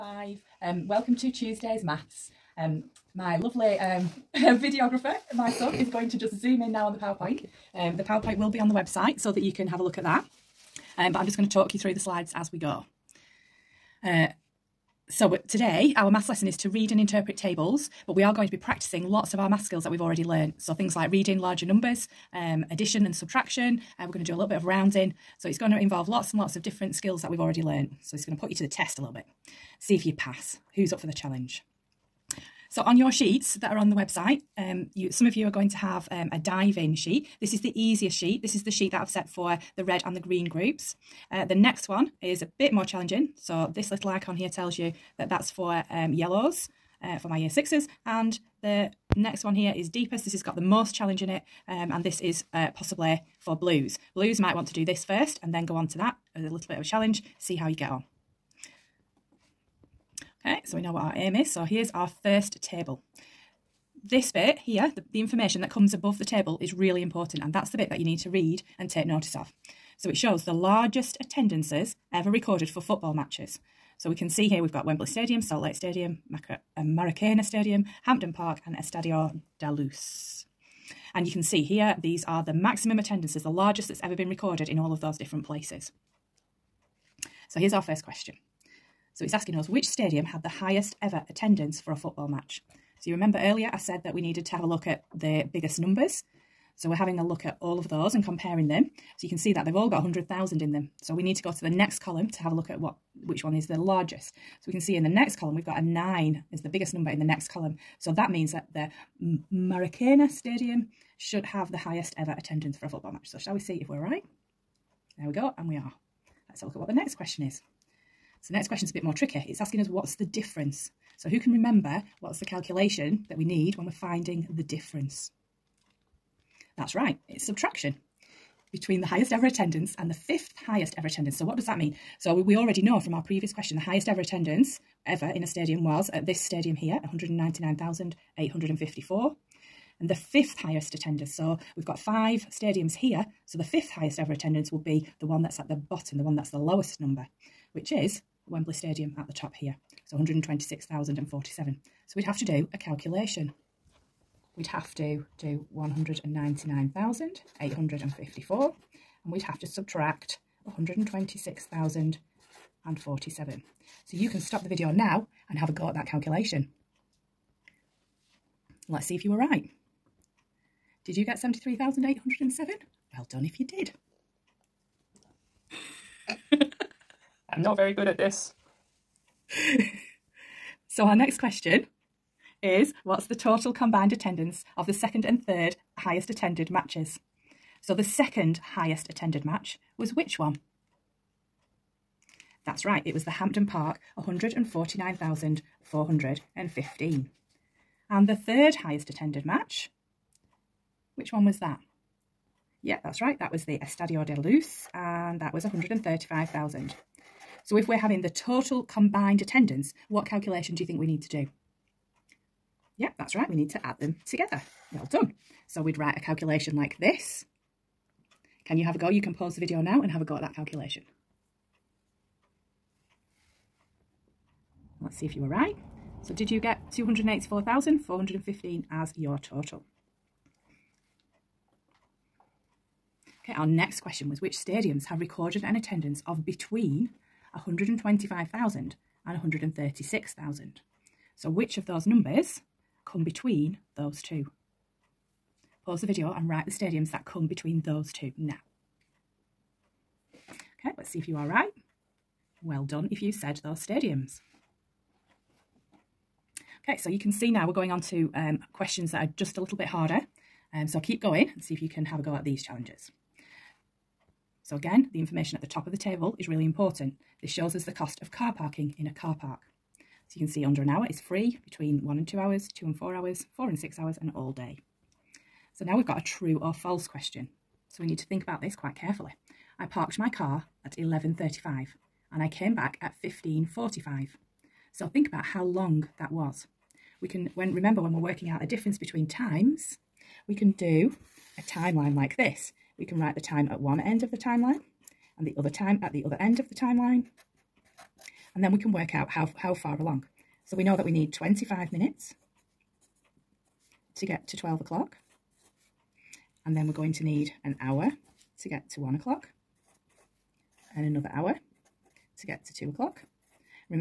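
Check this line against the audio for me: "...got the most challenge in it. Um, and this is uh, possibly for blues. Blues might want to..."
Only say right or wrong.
right.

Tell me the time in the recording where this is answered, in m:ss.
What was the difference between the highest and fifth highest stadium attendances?
2:51.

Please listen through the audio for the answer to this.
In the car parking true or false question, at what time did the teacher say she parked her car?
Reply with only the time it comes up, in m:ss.
4:40.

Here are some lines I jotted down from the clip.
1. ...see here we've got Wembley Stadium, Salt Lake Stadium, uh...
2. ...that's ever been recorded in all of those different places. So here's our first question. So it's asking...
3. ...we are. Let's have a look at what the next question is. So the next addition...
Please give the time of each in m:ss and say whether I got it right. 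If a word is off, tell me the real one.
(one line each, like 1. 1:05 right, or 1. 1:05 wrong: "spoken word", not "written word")
1. 1:14 right
2. 1:23 right
3. 1:55 wrong: "question", not "addition".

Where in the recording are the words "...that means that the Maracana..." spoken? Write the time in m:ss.
1:48.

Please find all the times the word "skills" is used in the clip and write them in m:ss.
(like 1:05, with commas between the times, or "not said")
0:19, 0:26.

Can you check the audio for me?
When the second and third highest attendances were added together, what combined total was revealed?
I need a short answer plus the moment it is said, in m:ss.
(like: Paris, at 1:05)
284,415, at 3:46.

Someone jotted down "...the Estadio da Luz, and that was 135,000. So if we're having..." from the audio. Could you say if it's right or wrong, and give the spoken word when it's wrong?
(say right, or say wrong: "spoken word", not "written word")
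right.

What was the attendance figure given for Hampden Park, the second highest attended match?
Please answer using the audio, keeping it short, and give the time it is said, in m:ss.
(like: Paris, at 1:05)
149,415, at 3:14.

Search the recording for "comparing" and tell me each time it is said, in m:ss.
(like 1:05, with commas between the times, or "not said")
1:38.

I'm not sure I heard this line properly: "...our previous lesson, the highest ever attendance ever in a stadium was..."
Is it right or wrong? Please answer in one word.
wrong.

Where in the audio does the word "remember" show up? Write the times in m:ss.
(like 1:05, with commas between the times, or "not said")
1:33, 2:01, 4:47.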